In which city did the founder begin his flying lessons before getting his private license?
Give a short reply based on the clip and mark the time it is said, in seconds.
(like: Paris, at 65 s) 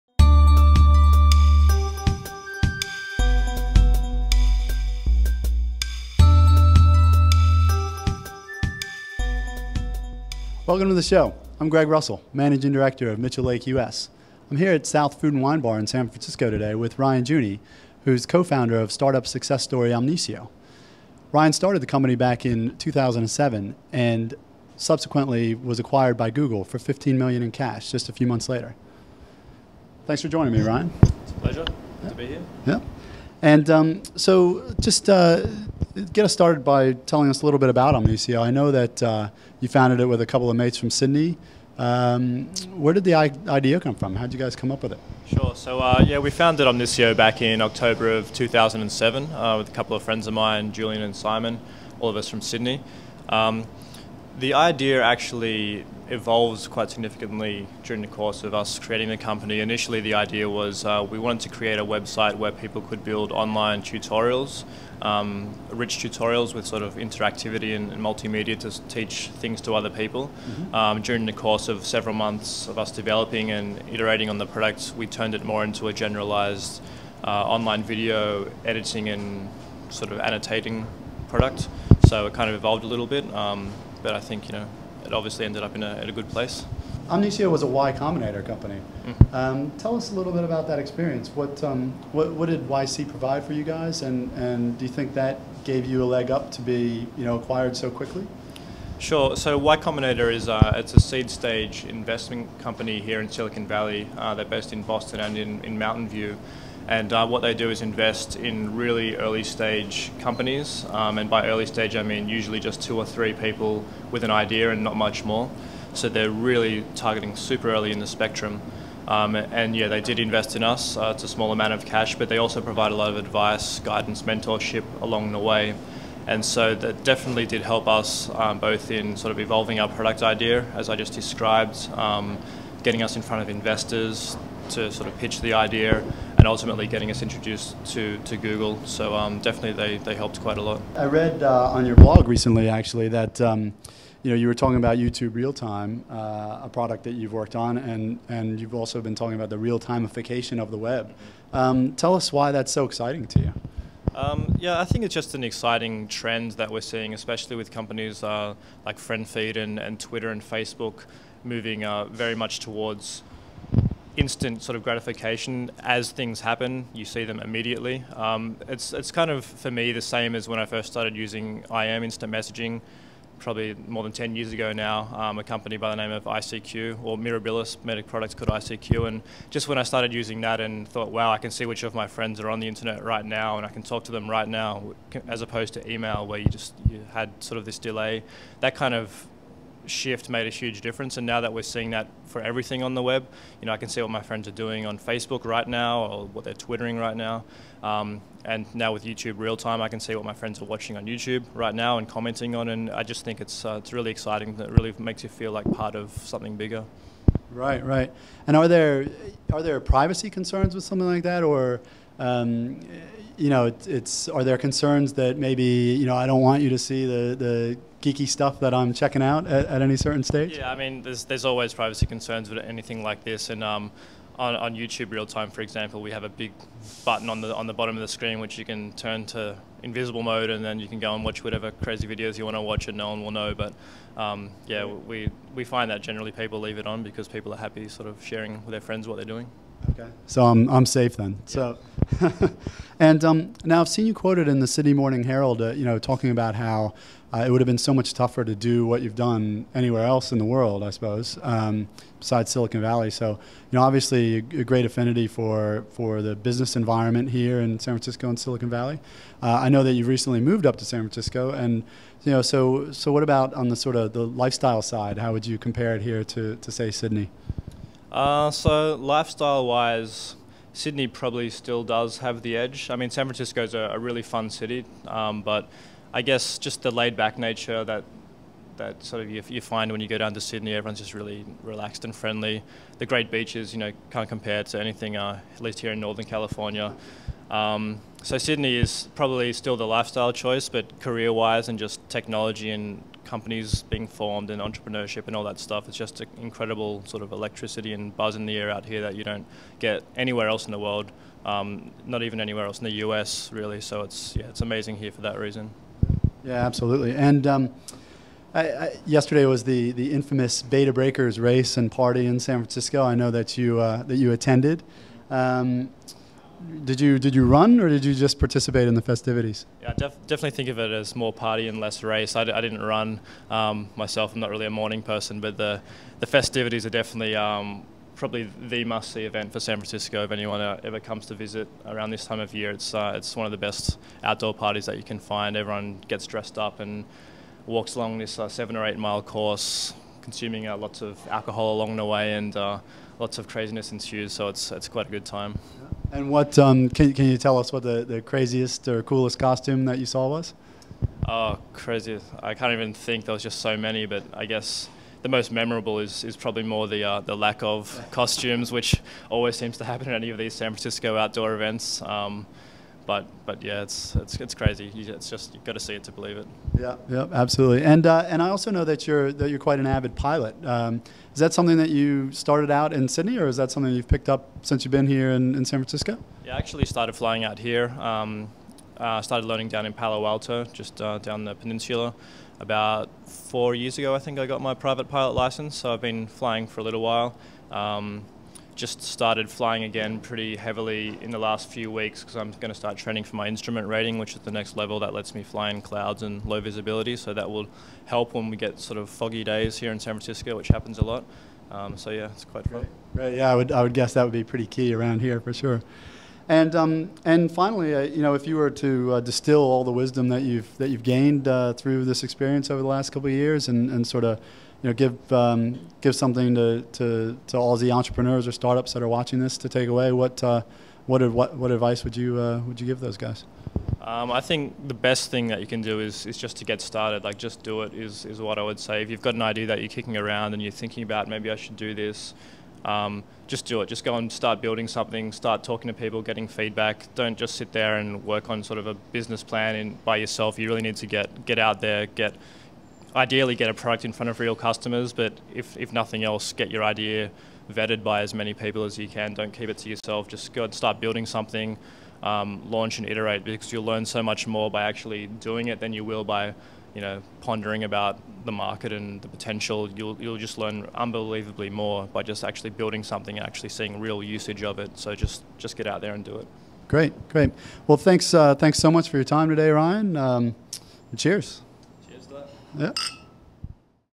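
Palo Alto, at 379 s.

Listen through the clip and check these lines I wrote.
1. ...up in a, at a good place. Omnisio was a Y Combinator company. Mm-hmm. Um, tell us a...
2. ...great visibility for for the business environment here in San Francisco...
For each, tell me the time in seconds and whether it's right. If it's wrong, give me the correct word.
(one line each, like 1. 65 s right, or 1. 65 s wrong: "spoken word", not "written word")
1. 85 s right
2. 254 s wrong: "affinity", not "visibility".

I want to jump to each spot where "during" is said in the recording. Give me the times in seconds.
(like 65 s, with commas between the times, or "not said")
57 s, 71 s.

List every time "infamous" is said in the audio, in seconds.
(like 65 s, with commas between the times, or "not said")
310 s.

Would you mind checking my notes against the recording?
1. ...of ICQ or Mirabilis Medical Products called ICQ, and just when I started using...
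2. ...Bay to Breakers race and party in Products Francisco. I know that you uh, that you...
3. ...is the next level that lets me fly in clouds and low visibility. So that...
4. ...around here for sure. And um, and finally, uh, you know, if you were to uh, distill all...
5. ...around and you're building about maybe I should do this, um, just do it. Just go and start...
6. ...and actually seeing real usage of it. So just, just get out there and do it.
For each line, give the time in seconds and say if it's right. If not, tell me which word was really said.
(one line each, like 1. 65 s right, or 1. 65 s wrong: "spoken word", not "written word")
1. 176 s right
2. 310 s wrong: "San", not "Products"
3. 394 s right
4. 404 s right
5. 430 s wrong: "thinking", not "building"
6. 463 s right.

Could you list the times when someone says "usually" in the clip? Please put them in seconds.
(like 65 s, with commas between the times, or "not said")
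112 s.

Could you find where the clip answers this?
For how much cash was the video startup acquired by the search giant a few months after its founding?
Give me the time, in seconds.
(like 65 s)
26 s.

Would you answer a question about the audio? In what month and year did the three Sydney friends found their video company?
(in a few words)
October 2007.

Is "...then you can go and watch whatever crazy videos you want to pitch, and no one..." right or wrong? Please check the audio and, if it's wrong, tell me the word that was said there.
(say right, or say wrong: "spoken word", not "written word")
wrong: "watch", not "pitch".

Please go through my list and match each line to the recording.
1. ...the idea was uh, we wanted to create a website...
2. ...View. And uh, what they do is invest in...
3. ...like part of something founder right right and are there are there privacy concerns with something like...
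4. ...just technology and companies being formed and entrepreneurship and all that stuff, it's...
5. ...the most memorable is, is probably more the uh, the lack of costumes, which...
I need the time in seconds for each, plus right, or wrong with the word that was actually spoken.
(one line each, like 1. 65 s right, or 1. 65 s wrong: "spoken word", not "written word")
1. 60 s right
2. 106 s right
3. 205 s wrong: "bigger", not "founder"
4. 291 s right
5. 355 s right.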